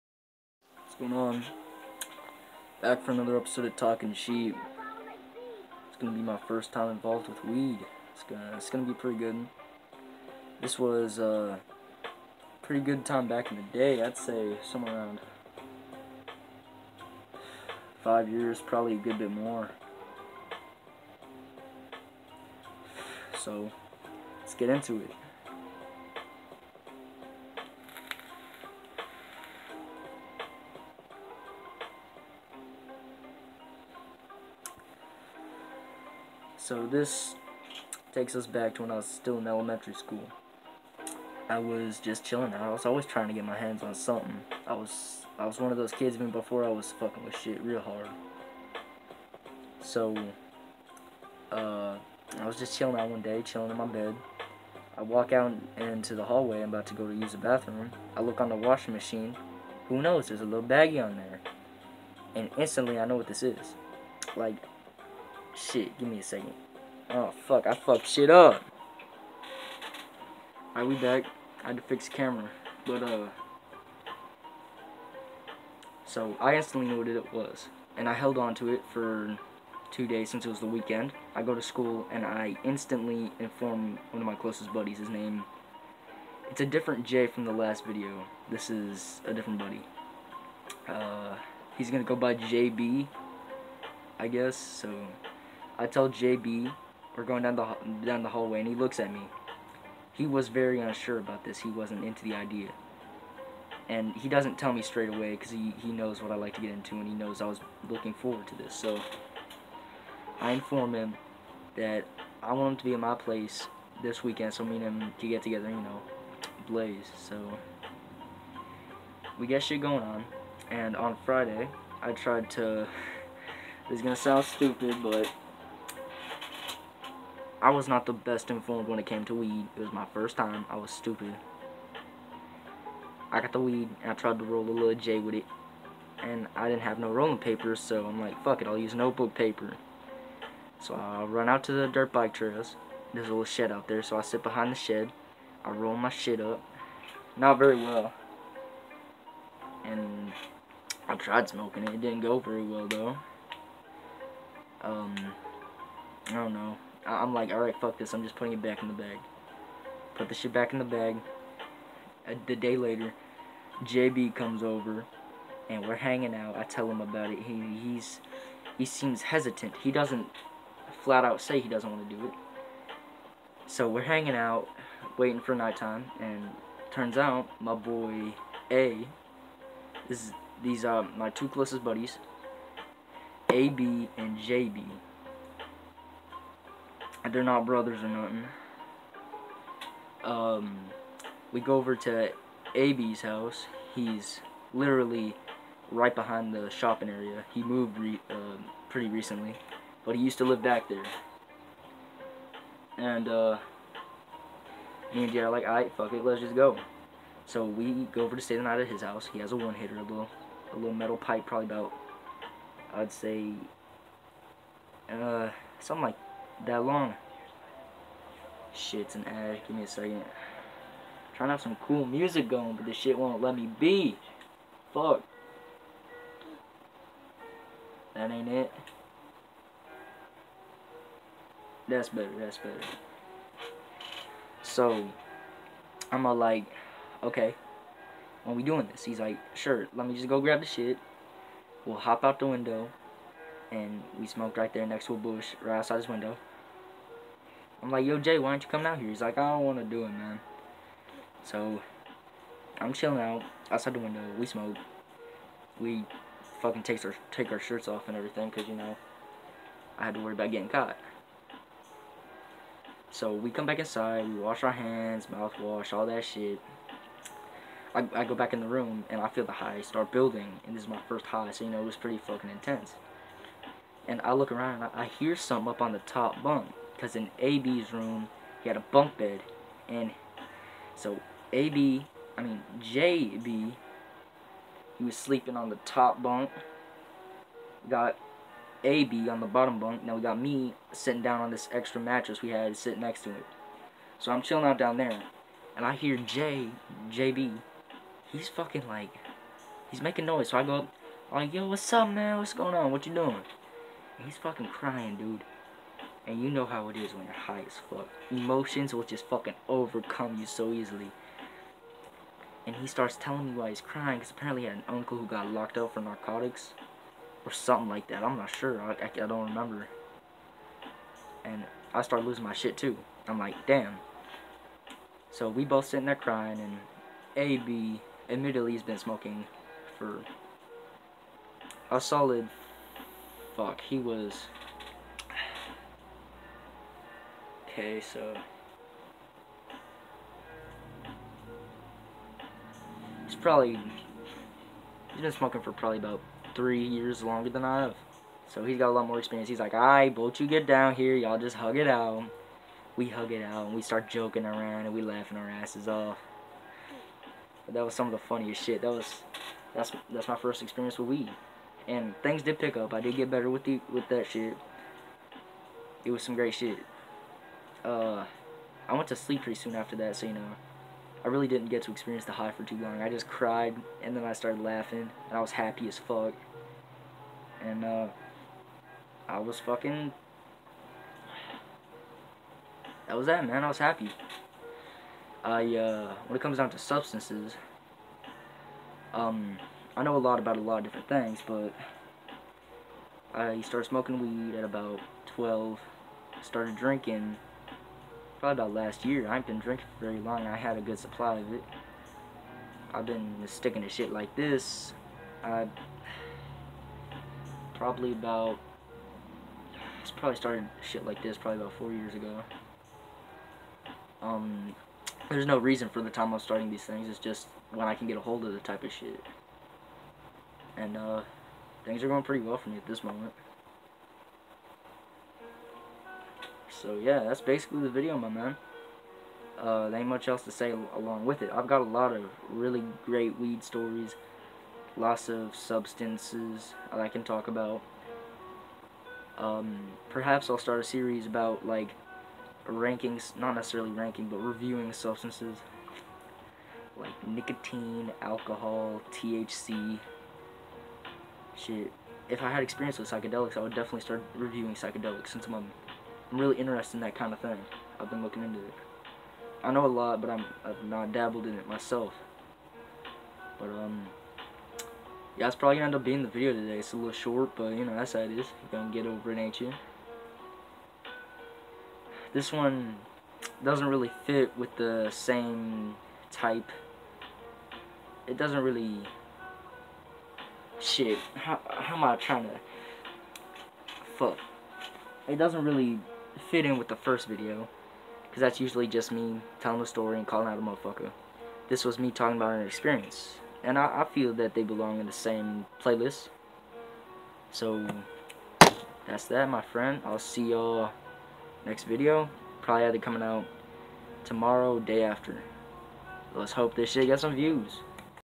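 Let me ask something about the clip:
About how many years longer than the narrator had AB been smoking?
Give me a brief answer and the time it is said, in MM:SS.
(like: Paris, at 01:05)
3, at 05:46.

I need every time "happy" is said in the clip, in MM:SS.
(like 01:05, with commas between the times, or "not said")
06:15, 06:23.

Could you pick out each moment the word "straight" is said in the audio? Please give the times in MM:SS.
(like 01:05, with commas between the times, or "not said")
01:44.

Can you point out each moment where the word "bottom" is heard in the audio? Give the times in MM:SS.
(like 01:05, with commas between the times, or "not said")
04:49.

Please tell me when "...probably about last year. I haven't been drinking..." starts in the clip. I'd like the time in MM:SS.
06:38.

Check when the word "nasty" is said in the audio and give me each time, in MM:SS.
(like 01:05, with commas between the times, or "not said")
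not said.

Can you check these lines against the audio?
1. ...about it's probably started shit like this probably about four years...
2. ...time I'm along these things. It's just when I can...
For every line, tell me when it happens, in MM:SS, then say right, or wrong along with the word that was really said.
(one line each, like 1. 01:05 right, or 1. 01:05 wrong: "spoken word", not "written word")
1. 06:48 right
2. 06:56 wrong: "starting", not "along".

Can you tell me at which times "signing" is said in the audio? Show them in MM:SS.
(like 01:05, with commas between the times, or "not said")
not said.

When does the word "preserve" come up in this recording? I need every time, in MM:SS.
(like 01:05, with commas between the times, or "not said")
not said.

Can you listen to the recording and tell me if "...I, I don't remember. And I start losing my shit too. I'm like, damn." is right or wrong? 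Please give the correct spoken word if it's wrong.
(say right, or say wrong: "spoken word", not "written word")
right.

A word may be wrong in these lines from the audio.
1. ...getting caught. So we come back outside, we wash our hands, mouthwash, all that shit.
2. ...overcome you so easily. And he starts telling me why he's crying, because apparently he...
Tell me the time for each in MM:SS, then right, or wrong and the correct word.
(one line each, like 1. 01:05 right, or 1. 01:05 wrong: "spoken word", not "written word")
1. 04:20 wrong: "inside", not "outside"
2. 05:09 right.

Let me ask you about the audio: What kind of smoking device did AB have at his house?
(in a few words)
A one hitter.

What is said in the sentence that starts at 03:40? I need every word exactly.
I'm trying to have some cool music going, but this shit won't let me be.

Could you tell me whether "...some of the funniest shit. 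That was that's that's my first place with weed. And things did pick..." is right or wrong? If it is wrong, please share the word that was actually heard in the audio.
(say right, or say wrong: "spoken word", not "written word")
wrong: "experience", not "place".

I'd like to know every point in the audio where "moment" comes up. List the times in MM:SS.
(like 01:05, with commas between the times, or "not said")
07:03.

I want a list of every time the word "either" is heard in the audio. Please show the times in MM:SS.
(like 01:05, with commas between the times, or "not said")
08:22.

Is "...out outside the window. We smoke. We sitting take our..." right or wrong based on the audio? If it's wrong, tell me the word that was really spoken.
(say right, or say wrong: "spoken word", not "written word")
wrong: "fucking", not "sitting".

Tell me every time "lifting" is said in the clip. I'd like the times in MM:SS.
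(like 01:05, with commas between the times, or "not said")
not said.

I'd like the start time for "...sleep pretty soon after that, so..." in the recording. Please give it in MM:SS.
06:09.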